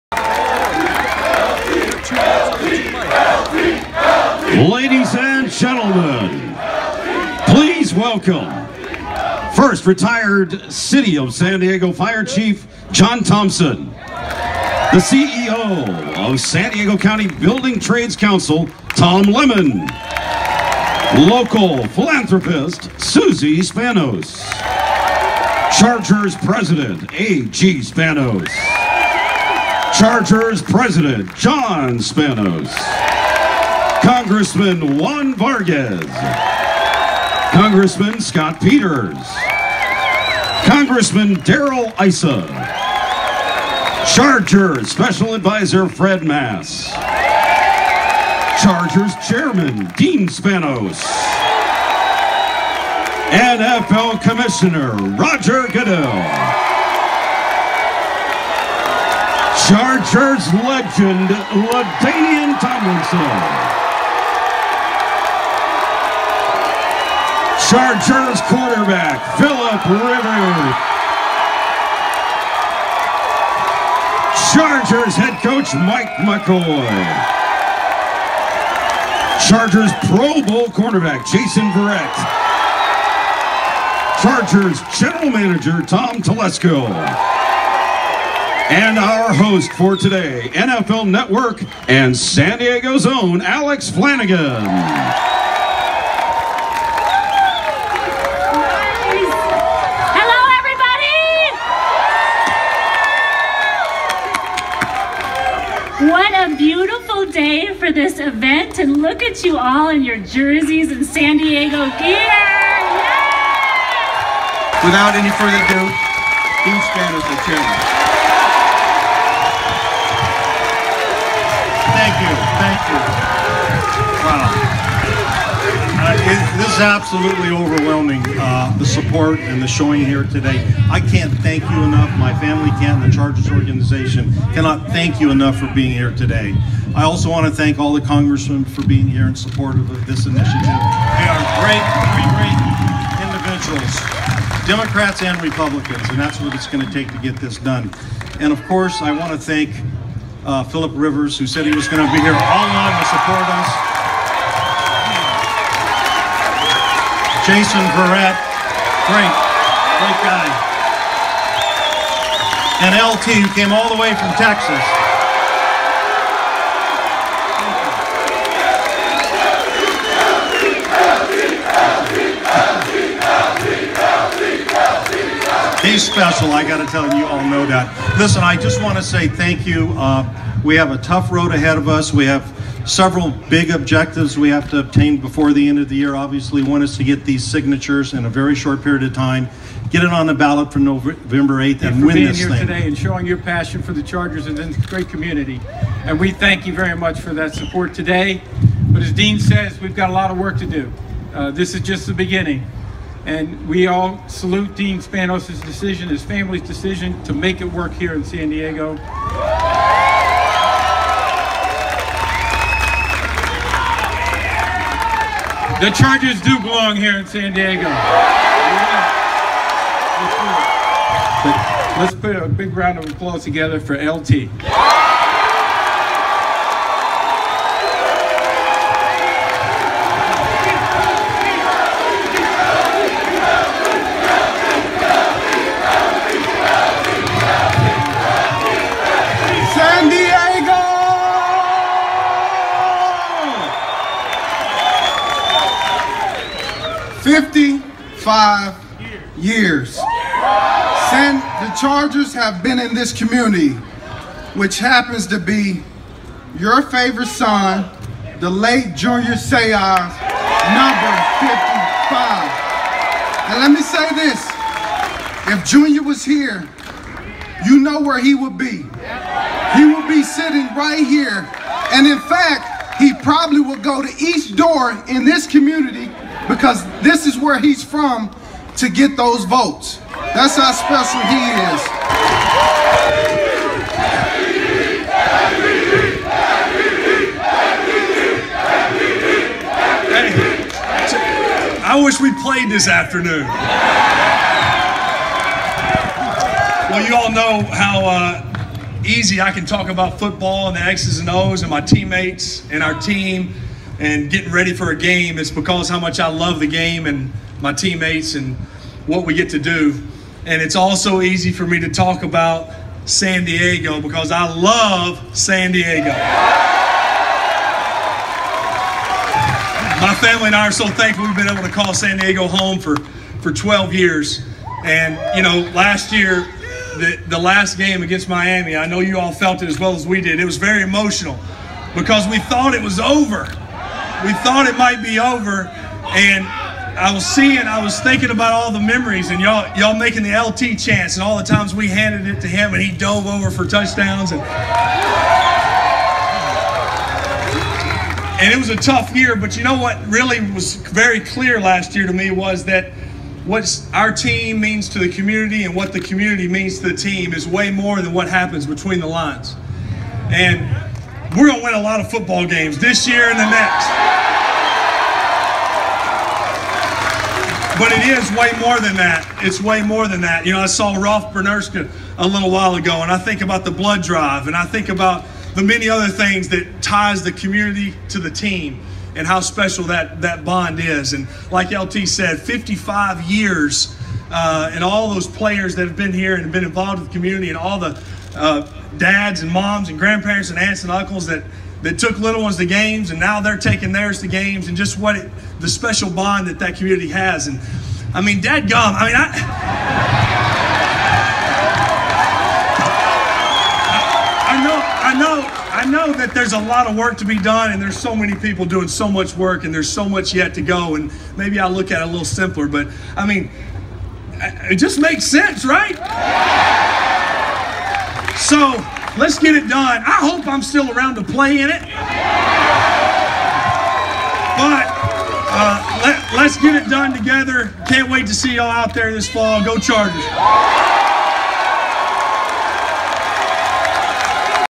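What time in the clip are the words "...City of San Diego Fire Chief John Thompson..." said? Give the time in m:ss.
0:10.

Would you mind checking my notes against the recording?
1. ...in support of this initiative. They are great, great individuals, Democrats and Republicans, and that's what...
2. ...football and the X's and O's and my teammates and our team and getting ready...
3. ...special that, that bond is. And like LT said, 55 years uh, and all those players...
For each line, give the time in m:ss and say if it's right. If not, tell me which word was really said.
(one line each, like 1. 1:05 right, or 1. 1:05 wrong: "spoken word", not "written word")
1. 2:19 right
2. 5:00 right
3. 6:19 right.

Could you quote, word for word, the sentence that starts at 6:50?
And maybe I look at it a little simpler, but I mean, it just makes sense, right?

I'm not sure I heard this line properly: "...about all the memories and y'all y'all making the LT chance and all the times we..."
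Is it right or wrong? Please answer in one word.
right.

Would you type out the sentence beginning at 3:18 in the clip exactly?
But as Dean says, we've got a lot of work to do.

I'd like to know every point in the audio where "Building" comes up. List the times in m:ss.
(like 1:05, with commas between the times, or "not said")
0:17.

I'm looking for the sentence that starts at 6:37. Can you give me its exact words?
And I mean, dad gum, I mean, I.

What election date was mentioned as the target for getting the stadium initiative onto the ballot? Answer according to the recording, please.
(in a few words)
November 8th.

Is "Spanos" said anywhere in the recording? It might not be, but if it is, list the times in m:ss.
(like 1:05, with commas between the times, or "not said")
0:23, 0:27, 0:31, 0:50, 3:24.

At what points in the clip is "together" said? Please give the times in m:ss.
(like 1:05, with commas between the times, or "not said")
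3:43, 7:07.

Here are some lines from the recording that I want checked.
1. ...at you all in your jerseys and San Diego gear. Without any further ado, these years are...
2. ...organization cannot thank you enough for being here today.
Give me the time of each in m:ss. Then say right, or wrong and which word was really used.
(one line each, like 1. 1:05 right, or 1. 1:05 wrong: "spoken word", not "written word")
1. 1:49 wrong: "banners", not "years"
2. 2:13 right.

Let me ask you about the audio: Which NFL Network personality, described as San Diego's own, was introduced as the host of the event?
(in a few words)
Alex Flanagan.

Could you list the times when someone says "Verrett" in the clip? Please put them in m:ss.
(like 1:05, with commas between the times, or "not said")
1:21, 2:37.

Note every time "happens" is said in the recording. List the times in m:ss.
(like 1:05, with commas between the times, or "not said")
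4:14, 5:58.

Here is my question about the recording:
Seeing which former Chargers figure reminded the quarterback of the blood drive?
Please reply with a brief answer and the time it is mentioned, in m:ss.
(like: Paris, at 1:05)
Rolf Benirschke, at 6:10.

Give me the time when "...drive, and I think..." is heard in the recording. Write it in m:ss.
6:14.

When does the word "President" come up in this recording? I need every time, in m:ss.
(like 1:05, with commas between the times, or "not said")
0:26, 0:30.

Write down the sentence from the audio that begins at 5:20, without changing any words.
My family and I are so thankful we've been able to call San Diego home for, for 12 years.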